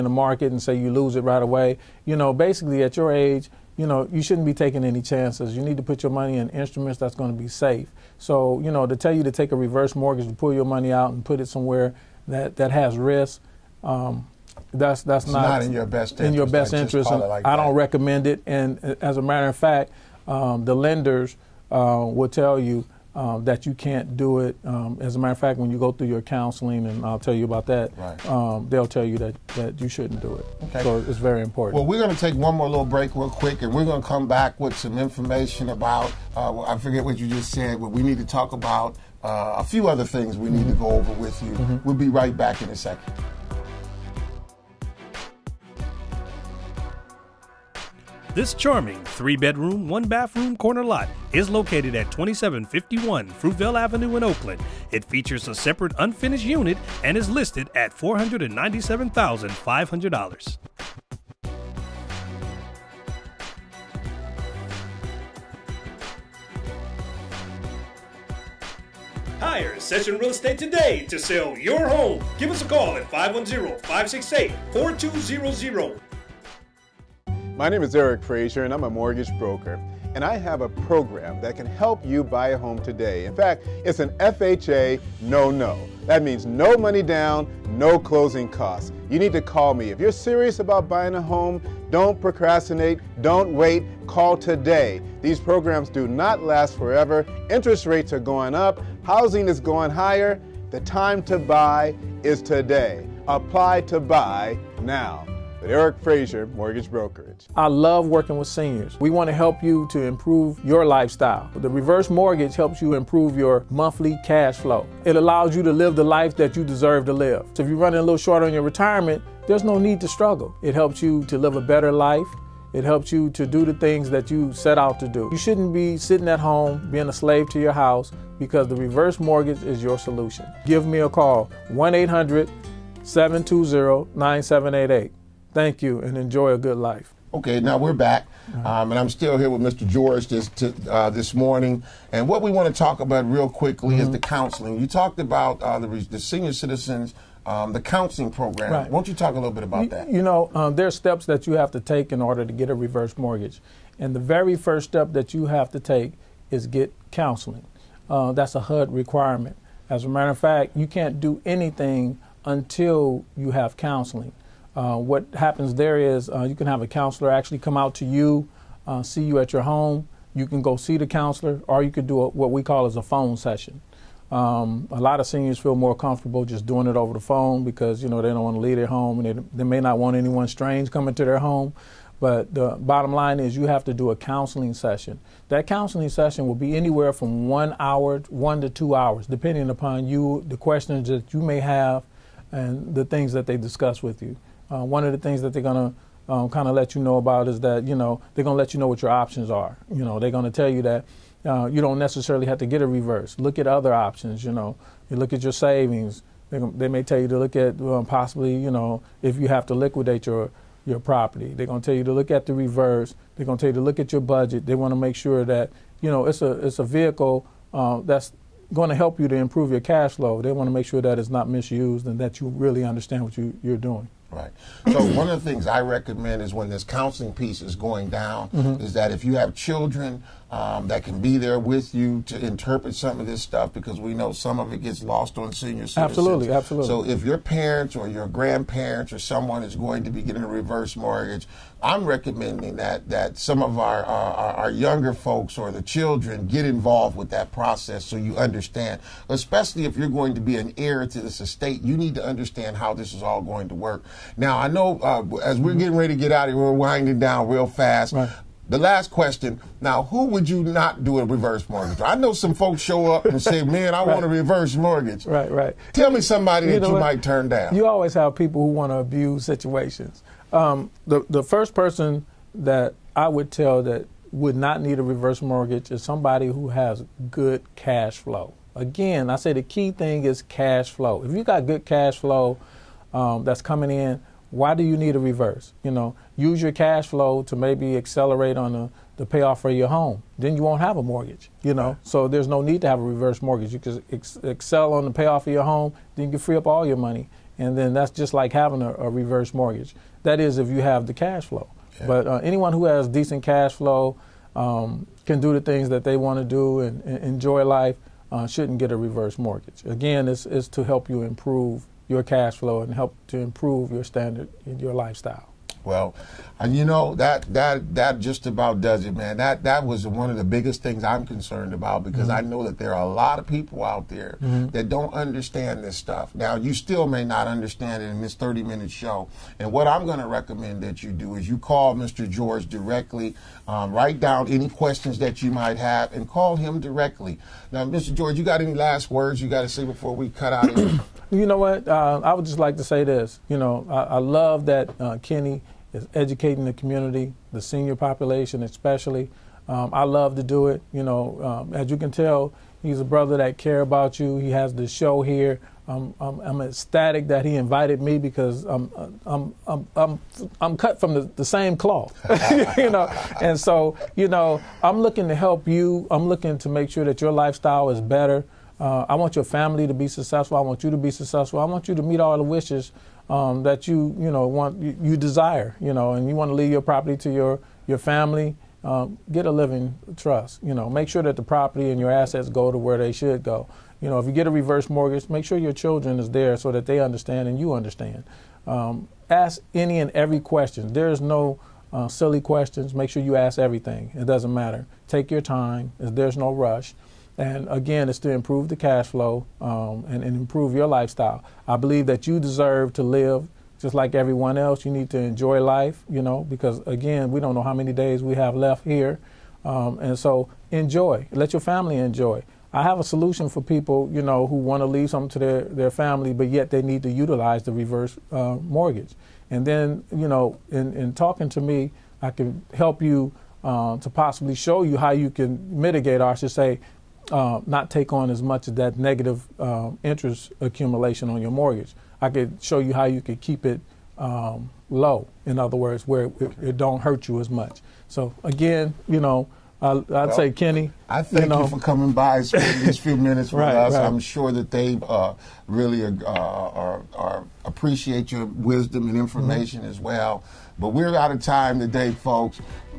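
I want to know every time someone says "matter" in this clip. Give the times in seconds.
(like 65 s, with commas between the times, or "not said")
19 s, 25 s, 160 s, 394 s.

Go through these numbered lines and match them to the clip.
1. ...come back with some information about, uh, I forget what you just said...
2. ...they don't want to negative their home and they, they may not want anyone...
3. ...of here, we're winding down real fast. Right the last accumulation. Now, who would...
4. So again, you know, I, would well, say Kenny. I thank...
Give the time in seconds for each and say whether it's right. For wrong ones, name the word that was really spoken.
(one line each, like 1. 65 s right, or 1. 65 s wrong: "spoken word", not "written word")
1. 34 s right
2. 178 s wrong: "leave", not "negative"
3. 256 s wrong: "question", not "accumulation"
4. 438 s right.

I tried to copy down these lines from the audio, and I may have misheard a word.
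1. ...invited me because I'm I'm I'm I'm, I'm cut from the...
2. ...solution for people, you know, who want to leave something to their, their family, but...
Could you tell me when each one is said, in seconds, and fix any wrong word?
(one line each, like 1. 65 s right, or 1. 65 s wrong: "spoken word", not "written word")
1. 357 s right
2. 413 s right.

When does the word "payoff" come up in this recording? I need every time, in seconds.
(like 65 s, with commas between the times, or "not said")
289 s, 295 s.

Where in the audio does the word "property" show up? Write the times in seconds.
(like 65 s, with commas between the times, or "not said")
210 s, 376 s, 381 s.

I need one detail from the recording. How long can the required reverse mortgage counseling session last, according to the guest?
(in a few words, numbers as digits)
1 to 2 hours.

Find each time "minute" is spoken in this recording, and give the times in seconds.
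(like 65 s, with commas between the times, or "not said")
328 s, 443 s.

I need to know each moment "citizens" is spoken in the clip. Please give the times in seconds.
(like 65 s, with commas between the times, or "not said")
146 s, 235 s.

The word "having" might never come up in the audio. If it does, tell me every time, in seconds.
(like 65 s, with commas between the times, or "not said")
298 s.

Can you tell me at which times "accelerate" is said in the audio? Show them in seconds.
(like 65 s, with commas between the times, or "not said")
287 s.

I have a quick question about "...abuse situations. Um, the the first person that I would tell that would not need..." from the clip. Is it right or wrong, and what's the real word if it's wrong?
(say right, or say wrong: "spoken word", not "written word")
right.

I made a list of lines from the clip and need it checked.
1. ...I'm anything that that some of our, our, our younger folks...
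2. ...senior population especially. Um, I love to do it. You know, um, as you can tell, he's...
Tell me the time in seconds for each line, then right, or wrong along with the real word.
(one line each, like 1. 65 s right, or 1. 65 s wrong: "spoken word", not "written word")
1. 241 s wrong: "recommending", not "anything"
2. 347 s right.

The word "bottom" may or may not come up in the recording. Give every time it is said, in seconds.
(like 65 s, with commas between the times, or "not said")
182 s.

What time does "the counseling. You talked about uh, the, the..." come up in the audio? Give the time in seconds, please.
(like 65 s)
144 s.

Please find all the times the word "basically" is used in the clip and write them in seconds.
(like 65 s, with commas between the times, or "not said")
2 s.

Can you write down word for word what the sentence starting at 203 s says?
Look at other options, you know.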